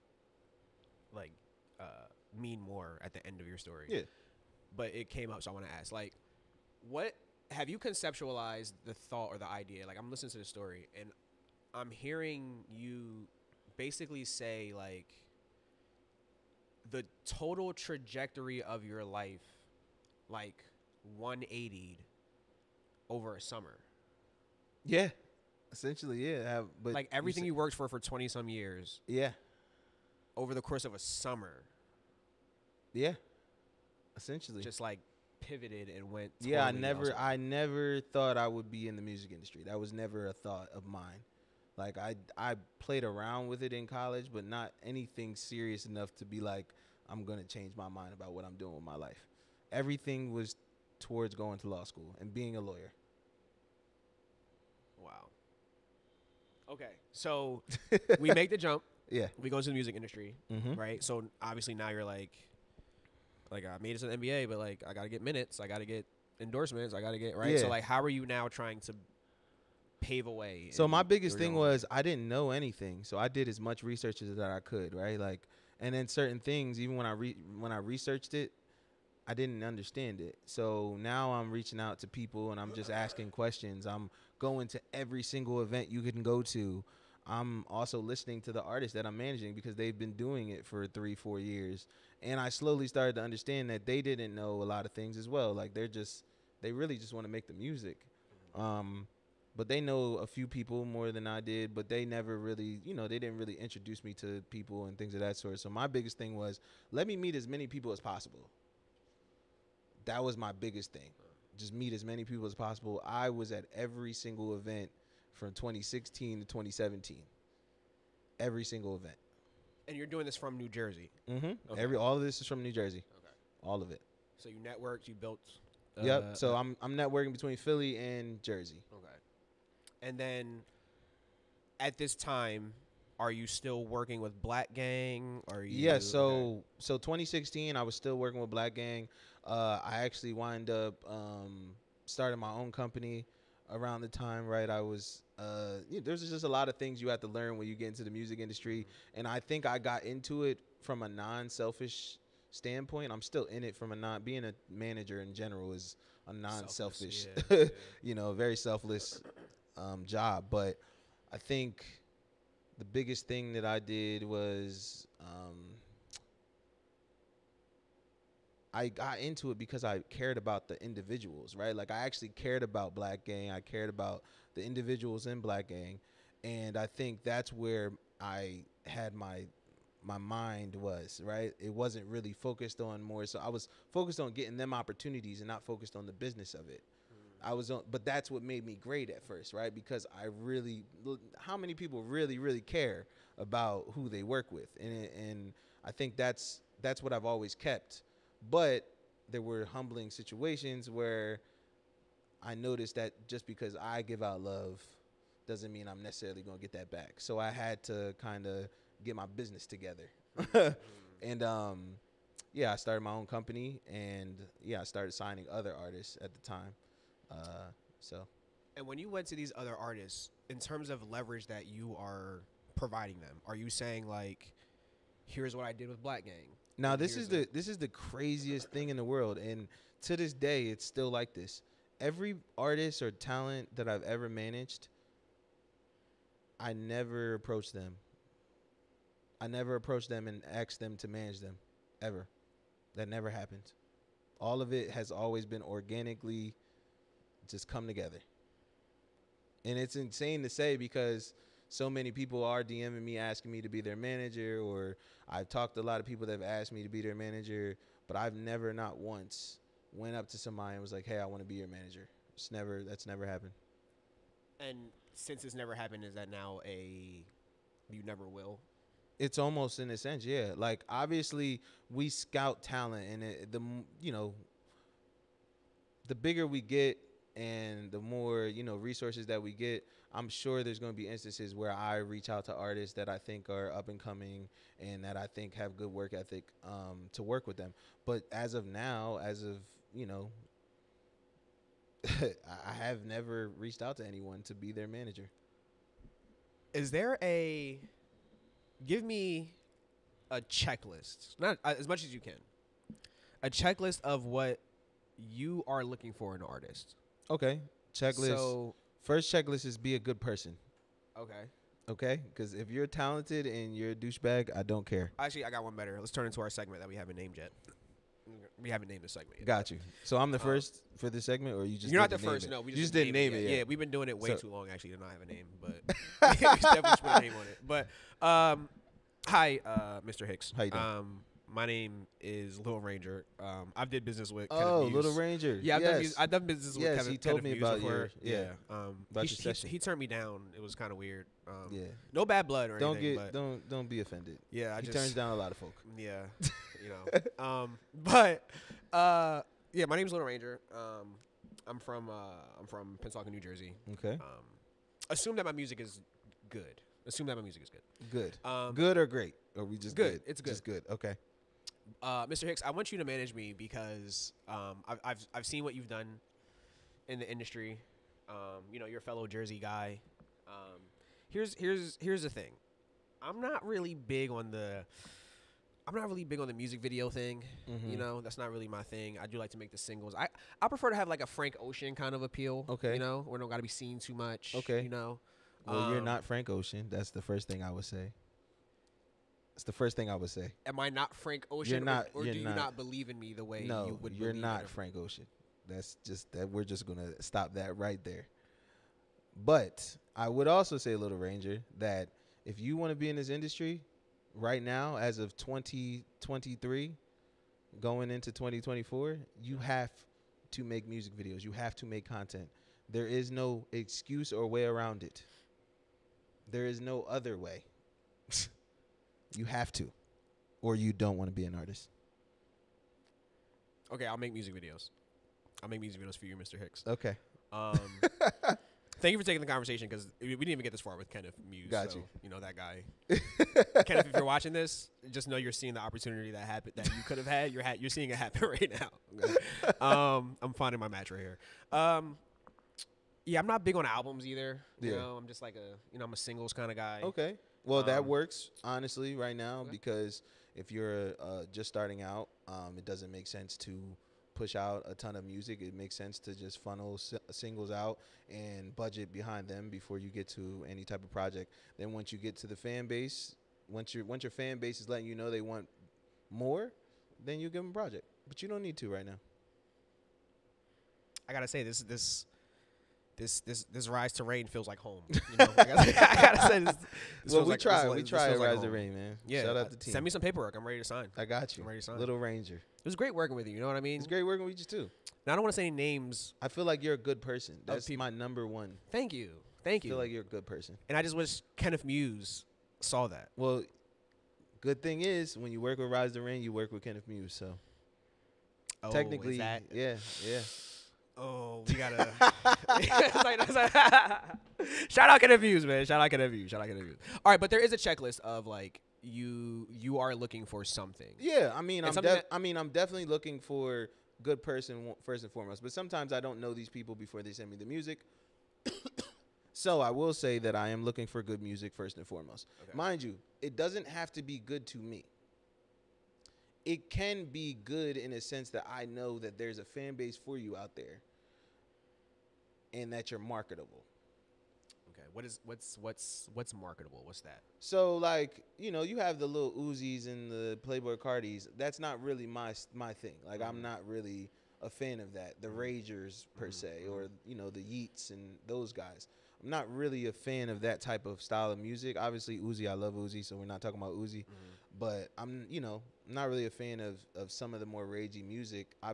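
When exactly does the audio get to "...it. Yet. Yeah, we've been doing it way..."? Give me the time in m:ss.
5:23.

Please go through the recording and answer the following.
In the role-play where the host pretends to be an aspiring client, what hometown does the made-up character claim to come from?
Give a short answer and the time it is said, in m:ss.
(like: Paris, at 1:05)
Pensacola, New Jersey, at 5:53.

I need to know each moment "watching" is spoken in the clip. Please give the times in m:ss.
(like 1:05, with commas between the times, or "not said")
7:14.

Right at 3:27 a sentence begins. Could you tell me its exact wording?
So I had to kind of get my business together.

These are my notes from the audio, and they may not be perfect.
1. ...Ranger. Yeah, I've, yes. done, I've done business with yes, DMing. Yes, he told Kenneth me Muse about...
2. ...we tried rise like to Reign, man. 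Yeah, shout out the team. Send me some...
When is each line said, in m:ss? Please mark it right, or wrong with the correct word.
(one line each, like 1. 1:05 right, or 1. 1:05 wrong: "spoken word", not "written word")
1. 5:35 wrong: "Kenneth", not "DMing"
2. 7:57 right.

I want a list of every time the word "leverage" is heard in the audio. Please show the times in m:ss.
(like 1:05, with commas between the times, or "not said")
3:41.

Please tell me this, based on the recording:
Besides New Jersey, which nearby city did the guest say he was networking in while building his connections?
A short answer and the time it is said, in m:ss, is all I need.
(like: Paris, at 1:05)
Philly, at 2:07.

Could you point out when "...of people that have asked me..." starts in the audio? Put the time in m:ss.
4:15.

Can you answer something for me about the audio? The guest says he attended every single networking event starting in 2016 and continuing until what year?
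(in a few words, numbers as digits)
2017.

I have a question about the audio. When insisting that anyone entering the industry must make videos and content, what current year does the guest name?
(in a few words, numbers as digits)
2023.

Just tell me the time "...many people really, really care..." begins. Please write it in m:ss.
3:11.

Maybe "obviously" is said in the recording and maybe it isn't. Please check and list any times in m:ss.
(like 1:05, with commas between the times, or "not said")
1:01, 4:30, 9:11.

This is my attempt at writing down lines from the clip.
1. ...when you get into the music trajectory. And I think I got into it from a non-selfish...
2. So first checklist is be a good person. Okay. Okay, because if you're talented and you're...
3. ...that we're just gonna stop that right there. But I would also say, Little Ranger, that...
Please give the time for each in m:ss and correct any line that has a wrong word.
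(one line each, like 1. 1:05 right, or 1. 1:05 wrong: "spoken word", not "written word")
1. 2:27 wrong: "industry", not "trajectory"
2. 5:08 right
3. 6:36 right.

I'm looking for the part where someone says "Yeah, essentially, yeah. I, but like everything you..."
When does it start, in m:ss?
0:24.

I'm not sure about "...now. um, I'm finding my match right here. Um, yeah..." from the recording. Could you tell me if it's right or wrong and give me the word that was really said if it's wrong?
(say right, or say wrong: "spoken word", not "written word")
right.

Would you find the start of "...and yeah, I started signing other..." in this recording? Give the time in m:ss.
3:33.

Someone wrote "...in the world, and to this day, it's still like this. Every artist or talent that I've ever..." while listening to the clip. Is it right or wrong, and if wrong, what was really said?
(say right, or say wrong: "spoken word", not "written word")
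right.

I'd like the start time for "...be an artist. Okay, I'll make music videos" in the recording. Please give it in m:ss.
7:01.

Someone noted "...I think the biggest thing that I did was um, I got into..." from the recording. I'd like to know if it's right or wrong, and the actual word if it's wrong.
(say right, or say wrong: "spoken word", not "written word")
right.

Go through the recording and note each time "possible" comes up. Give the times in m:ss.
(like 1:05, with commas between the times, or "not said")
1:47, 1:52.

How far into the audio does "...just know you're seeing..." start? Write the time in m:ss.
7:15.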